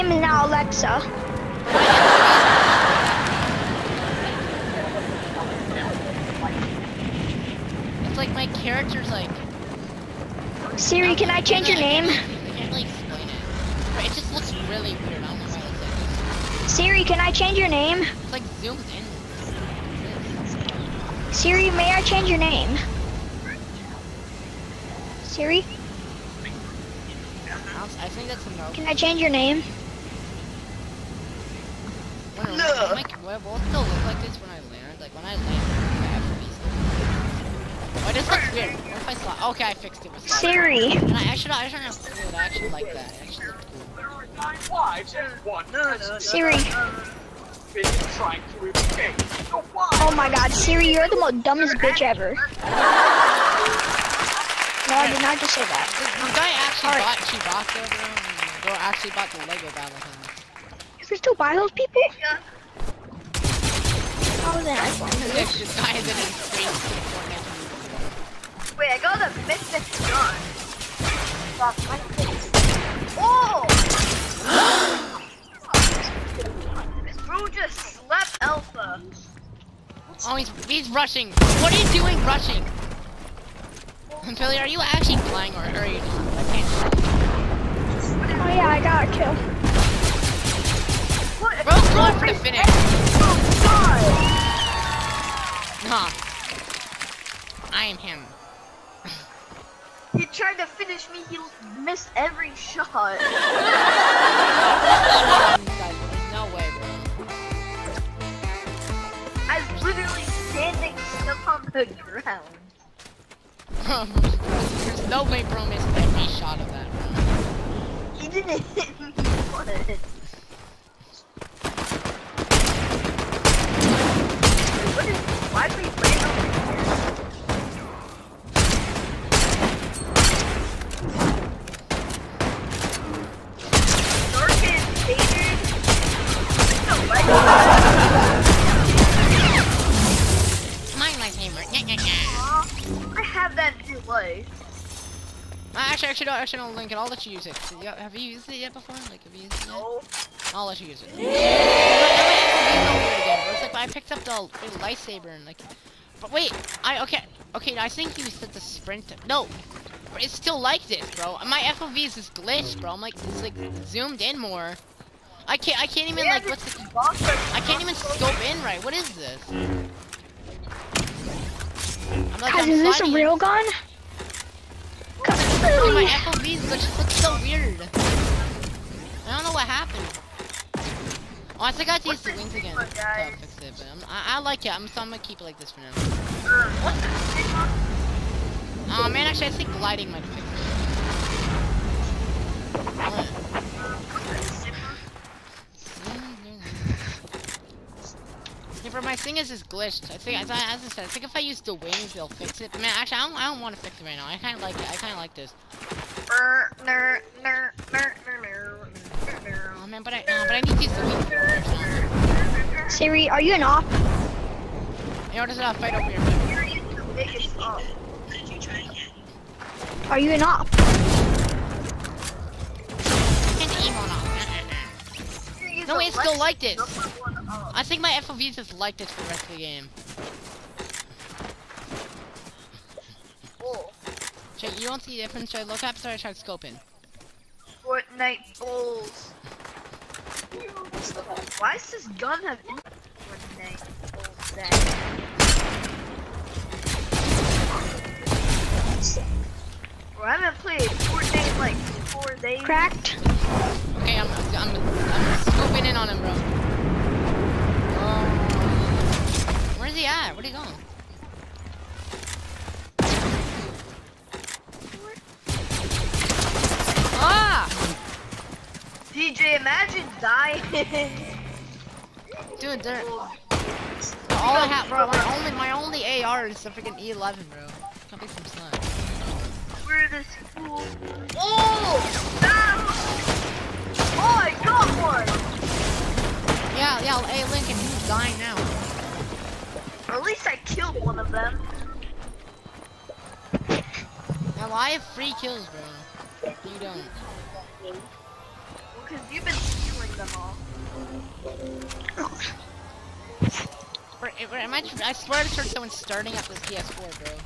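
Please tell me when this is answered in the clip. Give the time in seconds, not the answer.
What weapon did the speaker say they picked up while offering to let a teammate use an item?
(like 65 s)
154 s.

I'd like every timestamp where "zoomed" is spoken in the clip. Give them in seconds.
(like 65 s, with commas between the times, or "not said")
18 s, 163 s.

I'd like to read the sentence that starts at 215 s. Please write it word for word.
Yo, there's a fight over here.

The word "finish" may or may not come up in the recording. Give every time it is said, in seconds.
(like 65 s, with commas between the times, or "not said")
92 s, 100 s.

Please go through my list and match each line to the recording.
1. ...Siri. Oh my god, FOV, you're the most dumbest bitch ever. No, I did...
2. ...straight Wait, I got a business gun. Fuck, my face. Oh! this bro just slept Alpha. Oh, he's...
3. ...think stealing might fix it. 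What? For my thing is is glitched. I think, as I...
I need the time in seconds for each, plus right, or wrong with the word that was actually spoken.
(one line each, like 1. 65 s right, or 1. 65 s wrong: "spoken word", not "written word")
1. 46 s wrong: "Siri", not "FOV"
2. 66 s right
3. 189 s wrong: "gliding", not "stealing".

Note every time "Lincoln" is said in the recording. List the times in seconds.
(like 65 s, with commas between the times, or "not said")
287 s.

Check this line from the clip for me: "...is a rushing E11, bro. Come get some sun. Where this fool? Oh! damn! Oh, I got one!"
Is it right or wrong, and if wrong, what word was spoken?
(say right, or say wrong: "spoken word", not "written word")
wrong: "freaking", not "rushing".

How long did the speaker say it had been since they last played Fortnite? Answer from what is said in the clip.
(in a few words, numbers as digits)
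4 days.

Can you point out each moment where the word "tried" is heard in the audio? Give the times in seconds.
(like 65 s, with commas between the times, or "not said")
100 s, 236 s.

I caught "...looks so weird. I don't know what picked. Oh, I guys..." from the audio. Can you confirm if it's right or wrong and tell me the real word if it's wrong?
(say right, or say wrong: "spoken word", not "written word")
wrong: "happened", not "picked".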